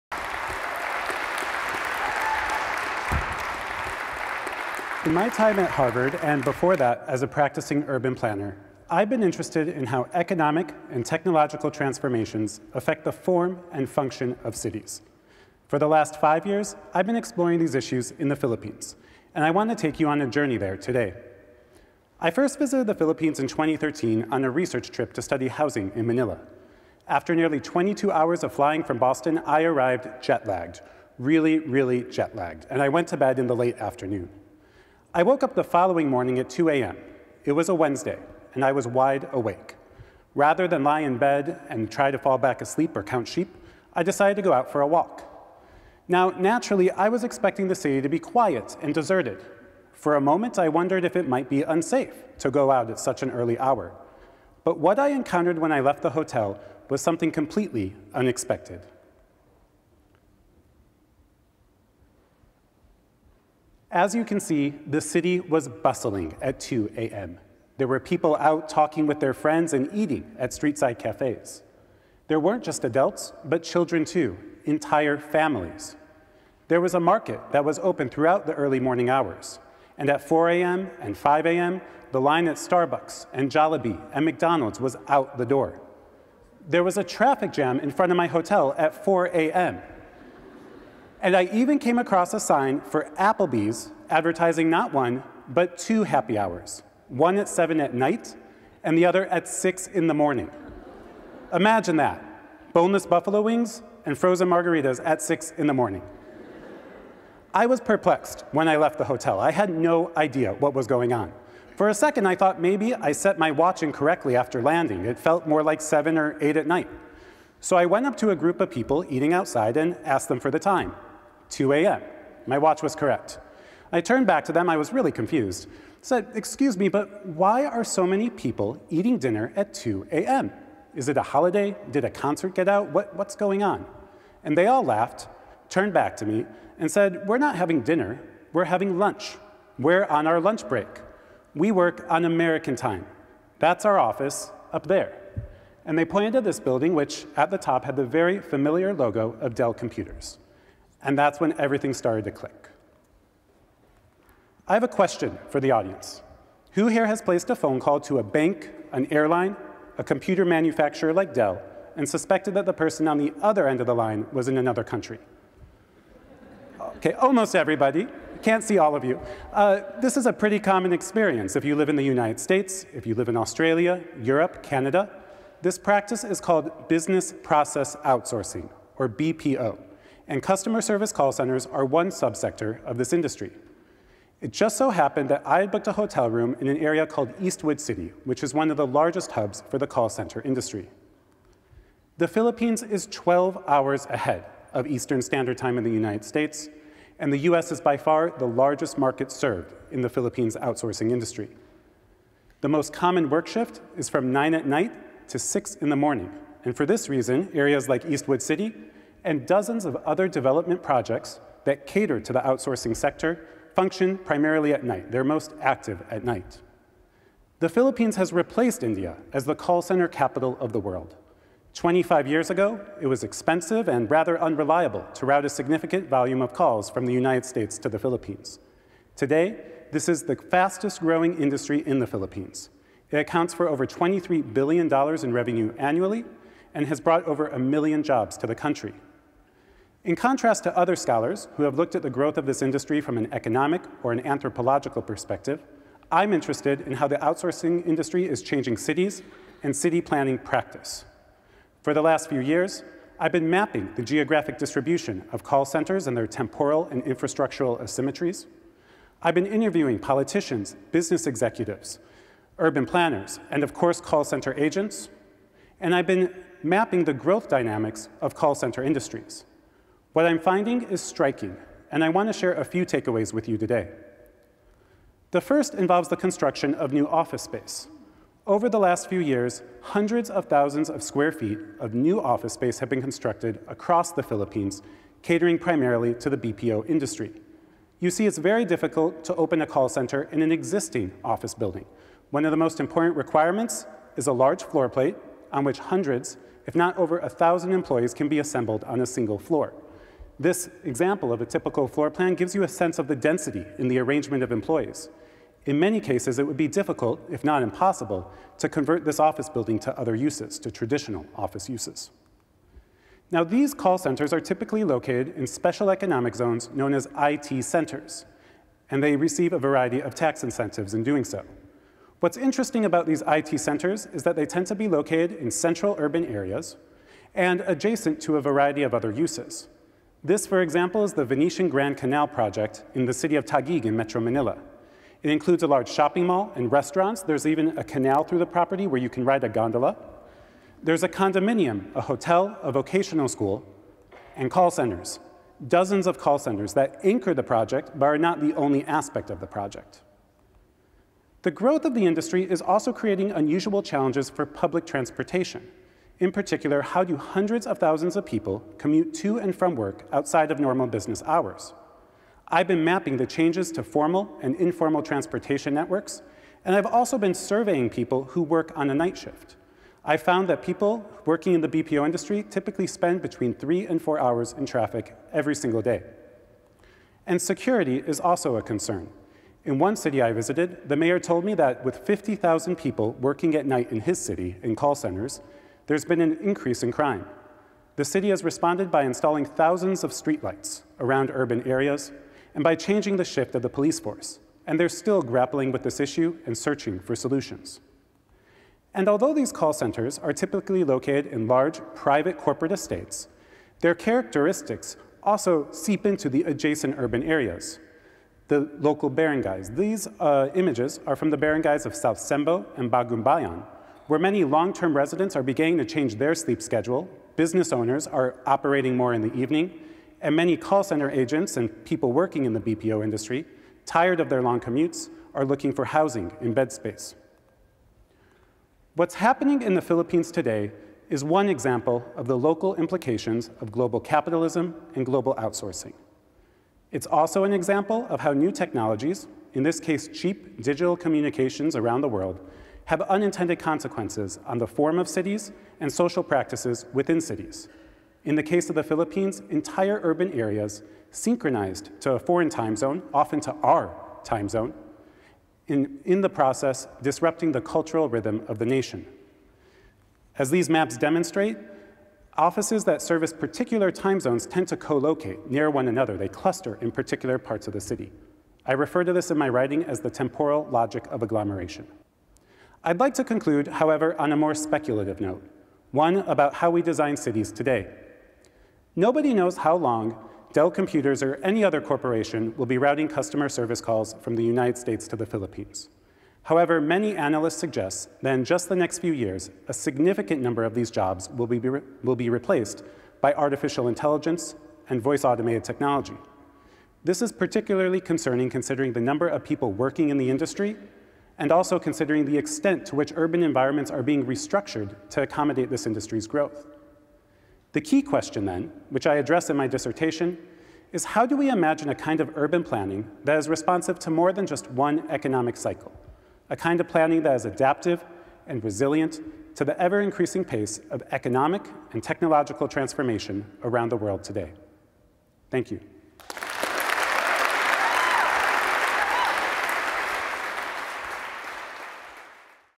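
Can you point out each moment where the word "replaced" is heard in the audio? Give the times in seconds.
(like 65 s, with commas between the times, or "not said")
218 s, 492 s.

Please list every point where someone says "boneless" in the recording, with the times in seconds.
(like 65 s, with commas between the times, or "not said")
102 s.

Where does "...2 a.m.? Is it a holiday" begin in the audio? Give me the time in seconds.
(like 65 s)
129 s.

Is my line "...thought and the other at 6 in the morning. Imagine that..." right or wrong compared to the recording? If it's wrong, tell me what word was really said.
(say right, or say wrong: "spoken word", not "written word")
wrong: "night", not "thought".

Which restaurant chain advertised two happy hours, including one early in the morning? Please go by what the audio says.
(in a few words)
Applebee's.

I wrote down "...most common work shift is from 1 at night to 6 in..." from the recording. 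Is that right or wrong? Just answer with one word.
wrong.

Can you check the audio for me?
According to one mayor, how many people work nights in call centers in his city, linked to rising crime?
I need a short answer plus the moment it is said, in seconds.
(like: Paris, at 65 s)
50,000, at 382 s.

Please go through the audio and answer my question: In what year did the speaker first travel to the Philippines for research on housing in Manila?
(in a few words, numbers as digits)
2013.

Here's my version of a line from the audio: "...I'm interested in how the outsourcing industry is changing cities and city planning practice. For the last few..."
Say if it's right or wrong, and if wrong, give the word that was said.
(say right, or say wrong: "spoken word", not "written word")
right.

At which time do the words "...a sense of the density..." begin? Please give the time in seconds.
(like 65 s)
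302 s.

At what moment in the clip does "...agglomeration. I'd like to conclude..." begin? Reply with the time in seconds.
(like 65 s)
471 s.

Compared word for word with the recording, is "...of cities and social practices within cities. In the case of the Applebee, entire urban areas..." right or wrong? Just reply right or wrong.
wrong.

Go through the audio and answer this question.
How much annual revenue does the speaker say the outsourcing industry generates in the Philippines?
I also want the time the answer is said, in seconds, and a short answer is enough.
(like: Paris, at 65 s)
over $23 billion, at 233 s.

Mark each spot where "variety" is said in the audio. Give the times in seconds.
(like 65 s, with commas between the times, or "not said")
319 s, 328 s.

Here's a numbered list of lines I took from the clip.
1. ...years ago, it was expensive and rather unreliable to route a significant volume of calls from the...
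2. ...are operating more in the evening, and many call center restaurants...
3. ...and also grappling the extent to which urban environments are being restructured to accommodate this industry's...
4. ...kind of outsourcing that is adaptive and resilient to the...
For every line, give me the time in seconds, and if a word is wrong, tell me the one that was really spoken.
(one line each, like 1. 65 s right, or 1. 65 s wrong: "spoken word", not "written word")
1. 222 s right
2. 418 s wrong: "agents", not "restaurants"
3. 501 s wrong: "considering", not "grappling"
4. 516 s wrong: "planning", not "outsourcing".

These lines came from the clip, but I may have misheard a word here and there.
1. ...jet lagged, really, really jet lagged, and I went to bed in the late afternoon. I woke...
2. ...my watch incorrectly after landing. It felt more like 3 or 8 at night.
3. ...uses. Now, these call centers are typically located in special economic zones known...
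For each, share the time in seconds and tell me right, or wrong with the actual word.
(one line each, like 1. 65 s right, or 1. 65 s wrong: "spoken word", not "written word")
1. 30 s right
2. 113 s wrong: "7", not "3"
3. 311 s right.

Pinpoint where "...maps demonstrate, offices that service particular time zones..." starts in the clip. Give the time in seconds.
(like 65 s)
460 s.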